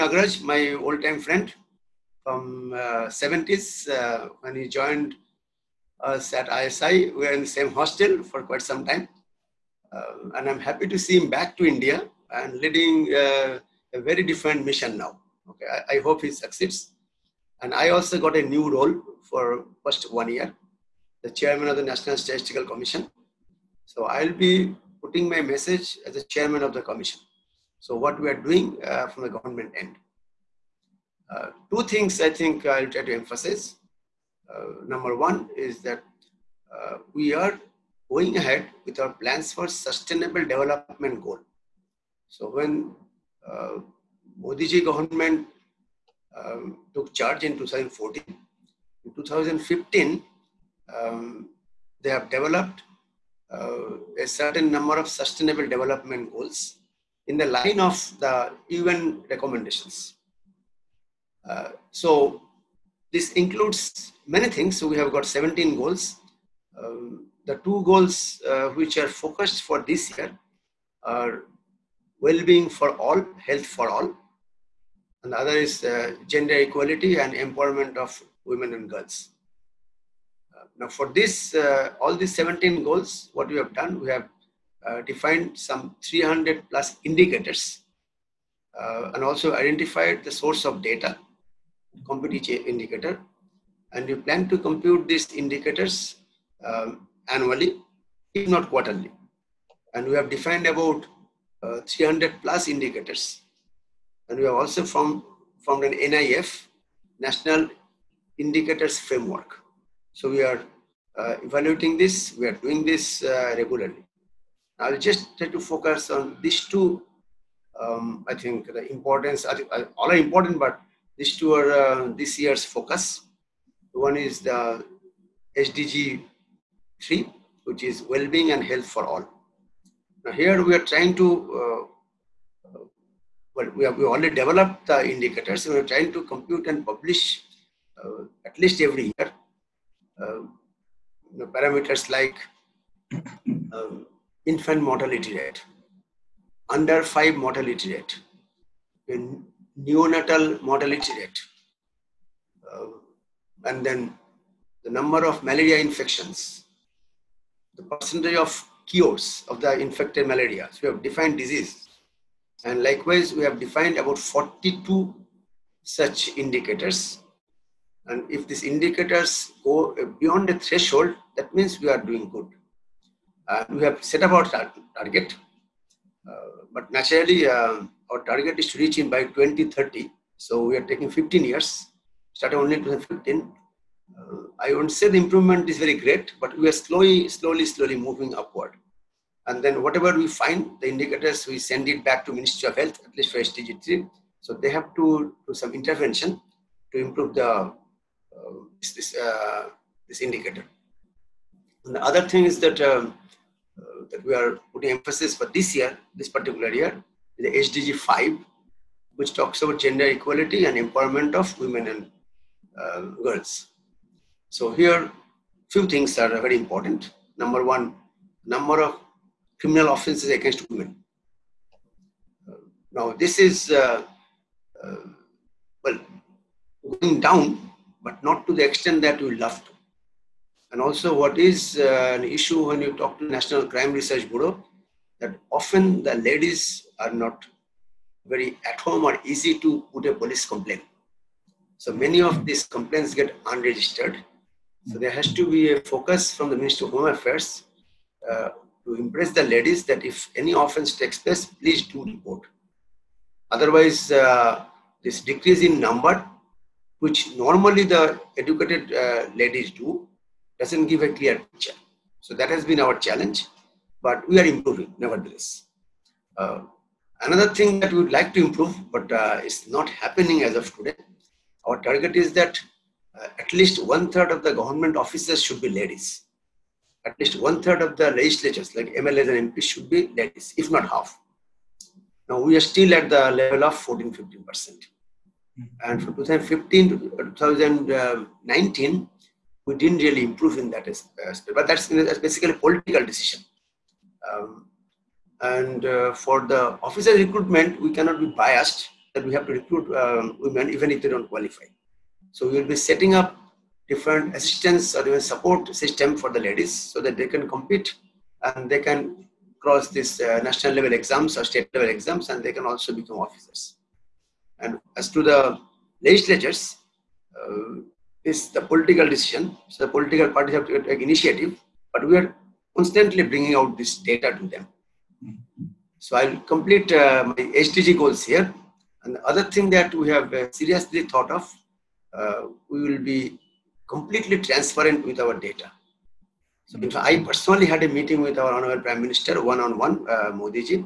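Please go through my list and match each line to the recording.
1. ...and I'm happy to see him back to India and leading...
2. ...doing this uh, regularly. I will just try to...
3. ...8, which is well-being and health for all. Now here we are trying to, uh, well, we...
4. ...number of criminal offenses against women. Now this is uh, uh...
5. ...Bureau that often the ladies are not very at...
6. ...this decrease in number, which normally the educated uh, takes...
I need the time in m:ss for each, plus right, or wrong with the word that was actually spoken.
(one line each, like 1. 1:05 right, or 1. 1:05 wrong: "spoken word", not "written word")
1. 0:10 right
2. 1:52 right
3. 2:07 wrong: "3", not "8"
4. 3:38 right
5. 3:54 right
6. 4:15 wrong: "ladies", not "takes".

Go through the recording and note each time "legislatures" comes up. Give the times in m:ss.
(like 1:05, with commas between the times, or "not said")
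4:38, 5:16.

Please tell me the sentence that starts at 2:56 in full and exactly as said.
Uh, but naturally, uh, our target is to reach in by 2030.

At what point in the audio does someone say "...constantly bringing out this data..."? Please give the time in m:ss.
5:22.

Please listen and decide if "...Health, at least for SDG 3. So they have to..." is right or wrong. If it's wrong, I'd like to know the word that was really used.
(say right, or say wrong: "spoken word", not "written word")
right.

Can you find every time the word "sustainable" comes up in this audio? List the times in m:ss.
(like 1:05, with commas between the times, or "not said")
0:39, 0:55.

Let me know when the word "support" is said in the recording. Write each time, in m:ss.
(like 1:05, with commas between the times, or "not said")
5:05.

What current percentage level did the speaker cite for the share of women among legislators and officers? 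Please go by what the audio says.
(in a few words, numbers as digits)
14-15%.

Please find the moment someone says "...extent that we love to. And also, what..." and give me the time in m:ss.
3:48.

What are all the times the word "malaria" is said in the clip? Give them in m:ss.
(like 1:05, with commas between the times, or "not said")
2:35, 2:40.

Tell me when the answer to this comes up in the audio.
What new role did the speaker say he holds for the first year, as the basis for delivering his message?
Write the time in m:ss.
0:21.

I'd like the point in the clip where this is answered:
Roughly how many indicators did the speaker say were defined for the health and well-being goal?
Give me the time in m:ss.
2:43.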